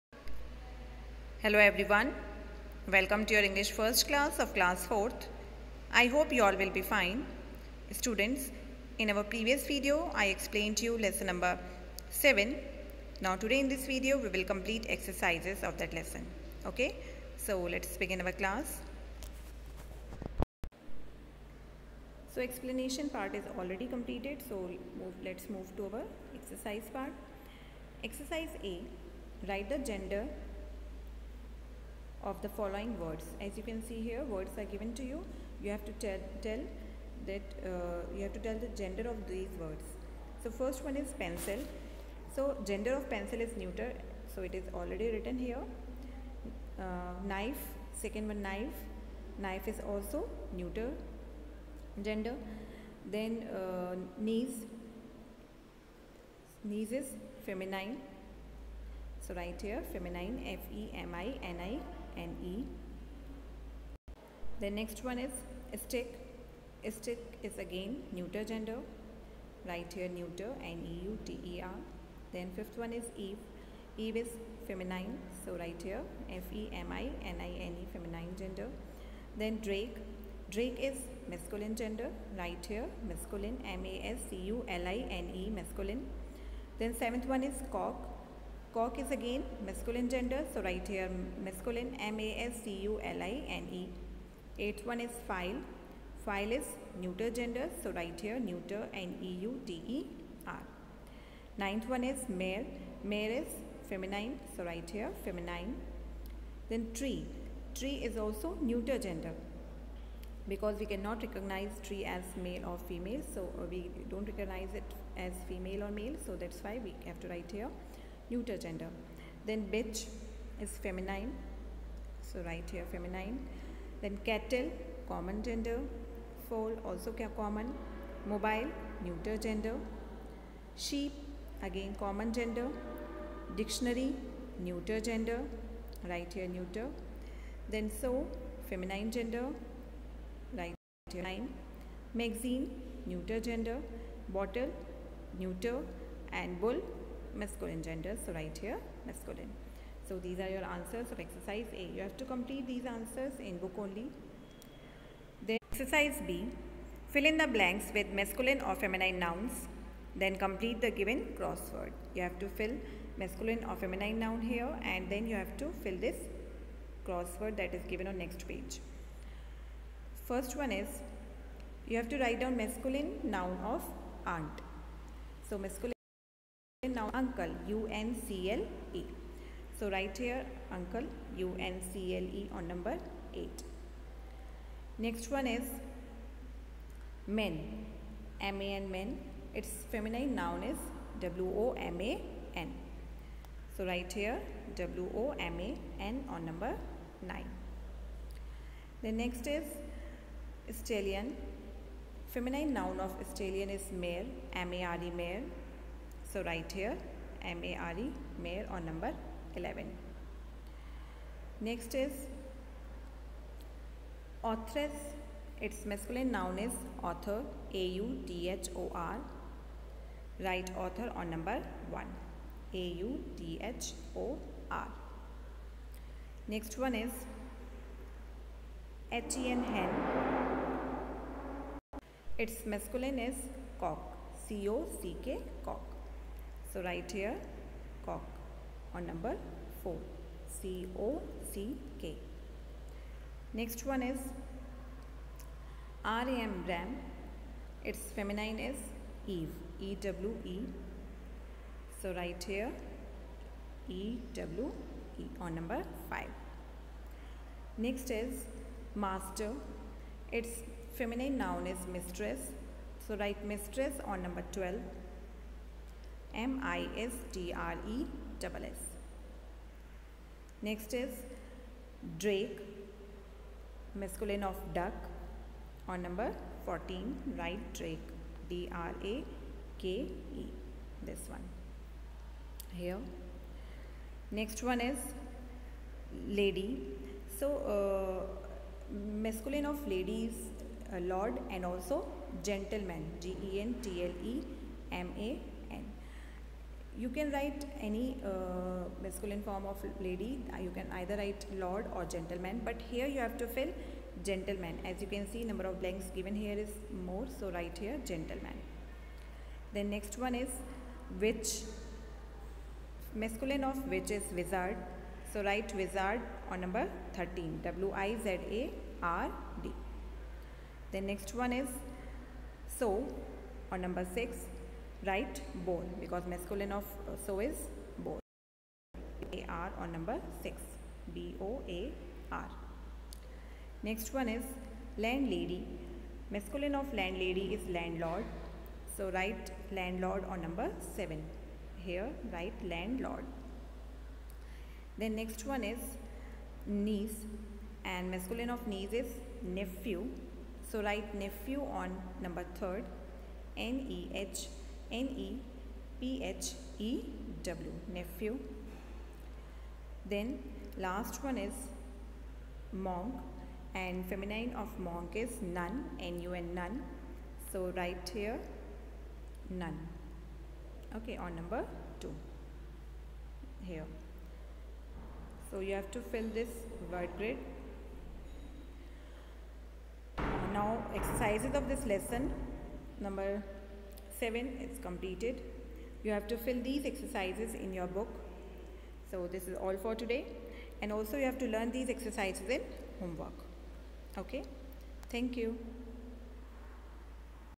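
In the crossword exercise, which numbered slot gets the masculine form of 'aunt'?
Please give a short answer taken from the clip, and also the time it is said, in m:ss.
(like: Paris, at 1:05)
8, at 3:02.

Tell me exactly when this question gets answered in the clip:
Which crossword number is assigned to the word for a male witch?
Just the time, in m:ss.
5:16.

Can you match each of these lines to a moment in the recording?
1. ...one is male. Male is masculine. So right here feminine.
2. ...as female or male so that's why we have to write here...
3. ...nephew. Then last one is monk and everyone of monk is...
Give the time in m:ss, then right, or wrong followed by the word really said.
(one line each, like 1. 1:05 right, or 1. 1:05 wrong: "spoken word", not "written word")
1. 1:41 wrong: "feminine", not "masculine"
2. 1:55 right
3. 5:57 wrong: "feminine", not "everyone".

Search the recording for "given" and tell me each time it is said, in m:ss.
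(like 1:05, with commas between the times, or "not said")
0:34, 2:40, 2:47, 5:06.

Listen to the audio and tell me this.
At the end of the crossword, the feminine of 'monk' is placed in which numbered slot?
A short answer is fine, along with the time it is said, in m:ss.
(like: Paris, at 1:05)
2, at 6:11.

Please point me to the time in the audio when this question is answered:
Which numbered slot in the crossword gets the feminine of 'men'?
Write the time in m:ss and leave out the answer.
3:16.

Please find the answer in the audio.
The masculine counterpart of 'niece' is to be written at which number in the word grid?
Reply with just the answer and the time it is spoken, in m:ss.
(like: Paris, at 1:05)
3, at 5:52.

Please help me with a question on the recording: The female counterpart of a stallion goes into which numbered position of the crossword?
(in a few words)
11.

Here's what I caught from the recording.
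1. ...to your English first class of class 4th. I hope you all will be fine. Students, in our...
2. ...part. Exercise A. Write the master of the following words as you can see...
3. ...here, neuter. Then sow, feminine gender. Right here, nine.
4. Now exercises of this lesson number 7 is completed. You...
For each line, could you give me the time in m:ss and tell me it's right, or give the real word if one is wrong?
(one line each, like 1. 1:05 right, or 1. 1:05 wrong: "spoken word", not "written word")
1. 0:03 right
2. 0:26 wrong: "gender", not "master"
3. 2:16 right
4. 6:20 right.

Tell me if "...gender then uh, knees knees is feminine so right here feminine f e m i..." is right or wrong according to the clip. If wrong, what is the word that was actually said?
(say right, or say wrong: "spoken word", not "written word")
right.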